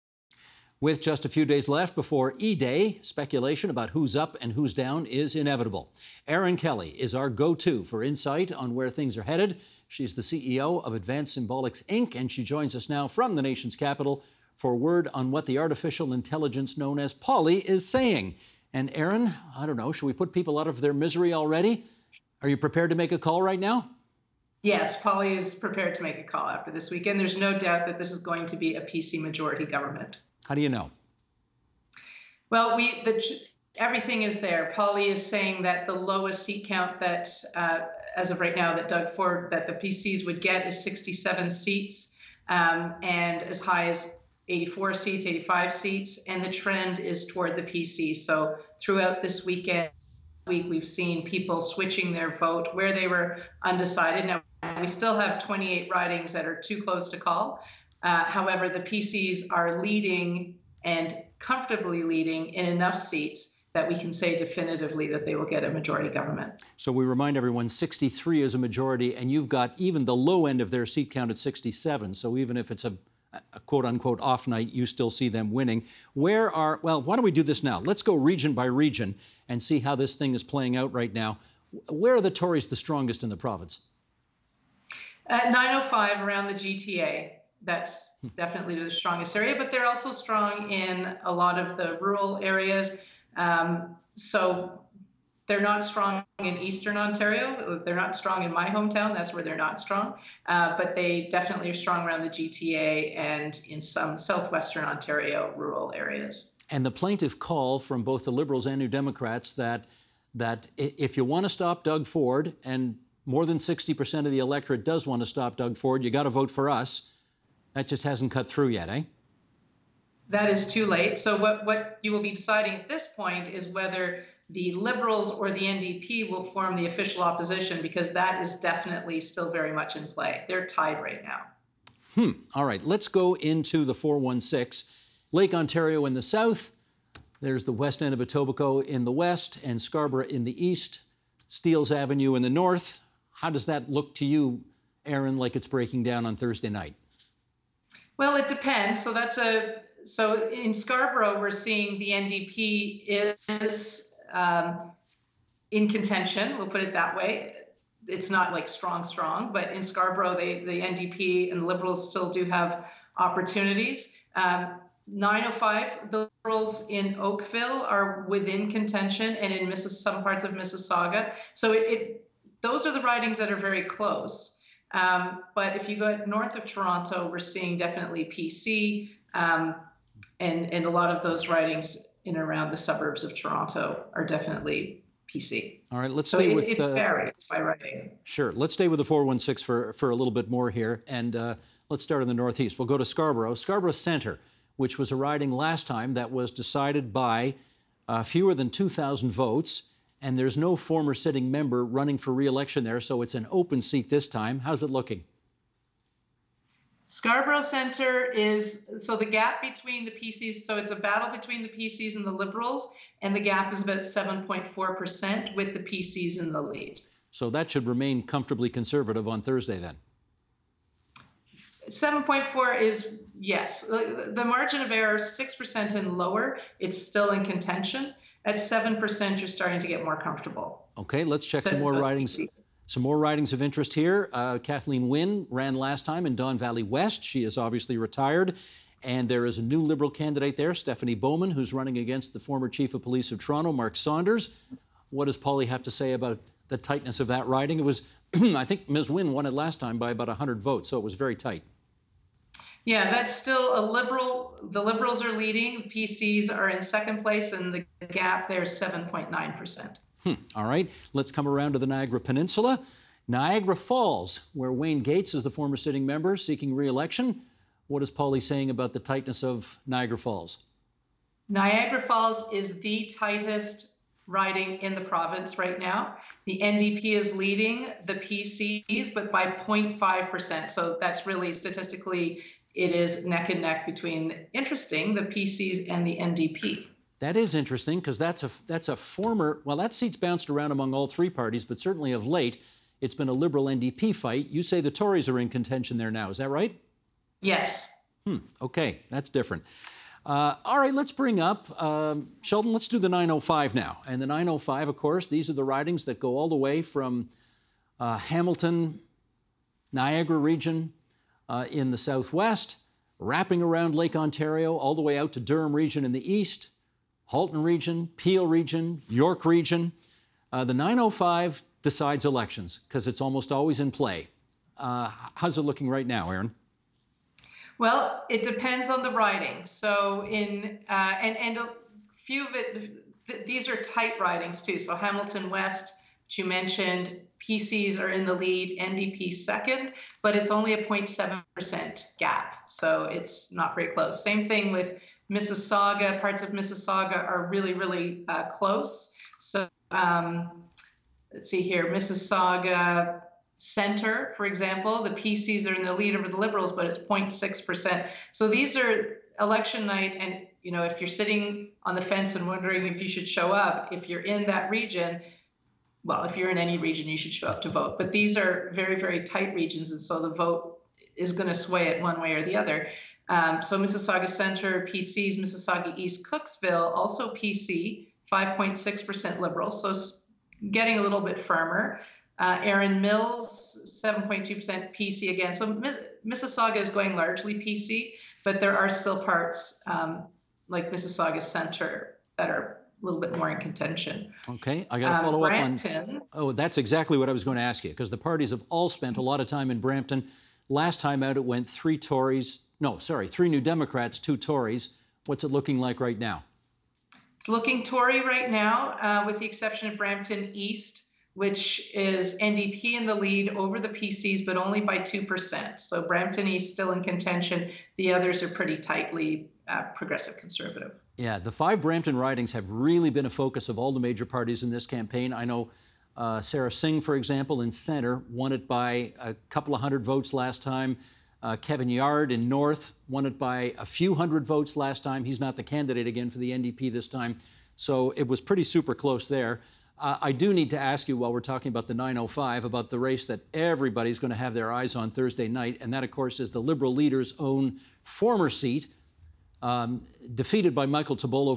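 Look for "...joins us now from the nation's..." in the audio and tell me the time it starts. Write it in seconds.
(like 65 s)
12 s.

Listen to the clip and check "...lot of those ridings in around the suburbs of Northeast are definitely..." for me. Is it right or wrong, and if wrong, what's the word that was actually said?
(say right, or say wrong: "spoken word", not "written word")
wrong: "Toronto", not "Northeast".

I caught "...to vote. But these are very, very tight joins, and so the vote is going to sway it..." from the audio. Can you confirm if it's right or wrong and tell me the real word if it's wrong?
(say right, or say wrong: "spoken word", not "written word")
wrong: "regions", not "joins".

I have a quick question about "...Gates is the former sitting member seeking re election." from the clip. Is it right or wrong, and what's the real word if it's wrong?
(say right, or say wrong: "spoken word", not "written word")
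right.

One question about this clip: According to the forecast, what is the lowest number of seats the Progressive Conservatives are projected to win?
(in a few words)
67.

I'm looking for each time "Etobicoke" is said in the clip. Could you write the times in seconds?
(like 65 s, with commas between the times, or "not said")
138 s.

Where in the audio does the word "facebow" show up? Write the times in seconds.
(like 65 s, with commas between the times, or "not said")
not said.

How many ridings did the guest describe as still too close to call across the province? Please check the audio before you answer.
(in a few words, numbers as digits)
28.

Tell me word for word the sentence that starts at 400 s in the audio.
Last time out, it went three Tories.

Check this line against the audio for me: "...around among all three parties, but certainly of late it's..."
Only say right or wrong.
right.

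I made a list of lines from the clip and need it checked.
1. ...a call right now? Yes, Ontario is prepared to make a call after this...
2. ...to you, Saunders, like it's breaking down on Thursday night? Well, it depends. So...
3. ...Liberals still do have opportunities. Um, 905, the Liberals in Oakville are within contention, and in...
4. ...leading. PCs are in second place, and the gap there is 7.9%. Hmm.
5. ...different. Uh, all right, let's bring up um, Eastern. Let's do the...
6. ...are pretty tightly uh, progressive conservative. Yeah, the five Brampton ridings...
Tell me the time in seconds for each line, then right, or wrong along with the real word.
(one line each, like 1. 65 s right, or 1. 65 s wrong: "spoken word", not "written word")
1. 23 s wrong: "Polly", not "Ontario"
2. 144 s wrong: "Erin", not "Saunders"
3. 161 s right
4. 255 s right
5. 299 s wrong: "Sheldon", not "Eastern"
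6. 418 s right.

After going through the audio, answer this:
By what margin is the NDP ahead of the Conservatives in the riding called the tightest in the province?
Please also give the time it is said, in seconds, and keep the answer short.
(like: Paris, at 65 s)
0.5%, at 279 s.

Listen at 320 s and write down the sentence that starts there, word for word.
Uh, the 905 decides elections because it's almost always in play.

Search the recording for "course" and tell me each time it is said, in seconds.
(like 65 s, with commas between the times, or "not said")
304 s, 446 s.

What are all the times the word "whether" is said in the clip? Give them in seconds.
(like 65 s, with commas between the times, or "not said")
123 s.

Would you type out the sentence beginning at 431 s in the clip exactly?
Uh, Kevin Yarde in north won it by a few hundred votes last time.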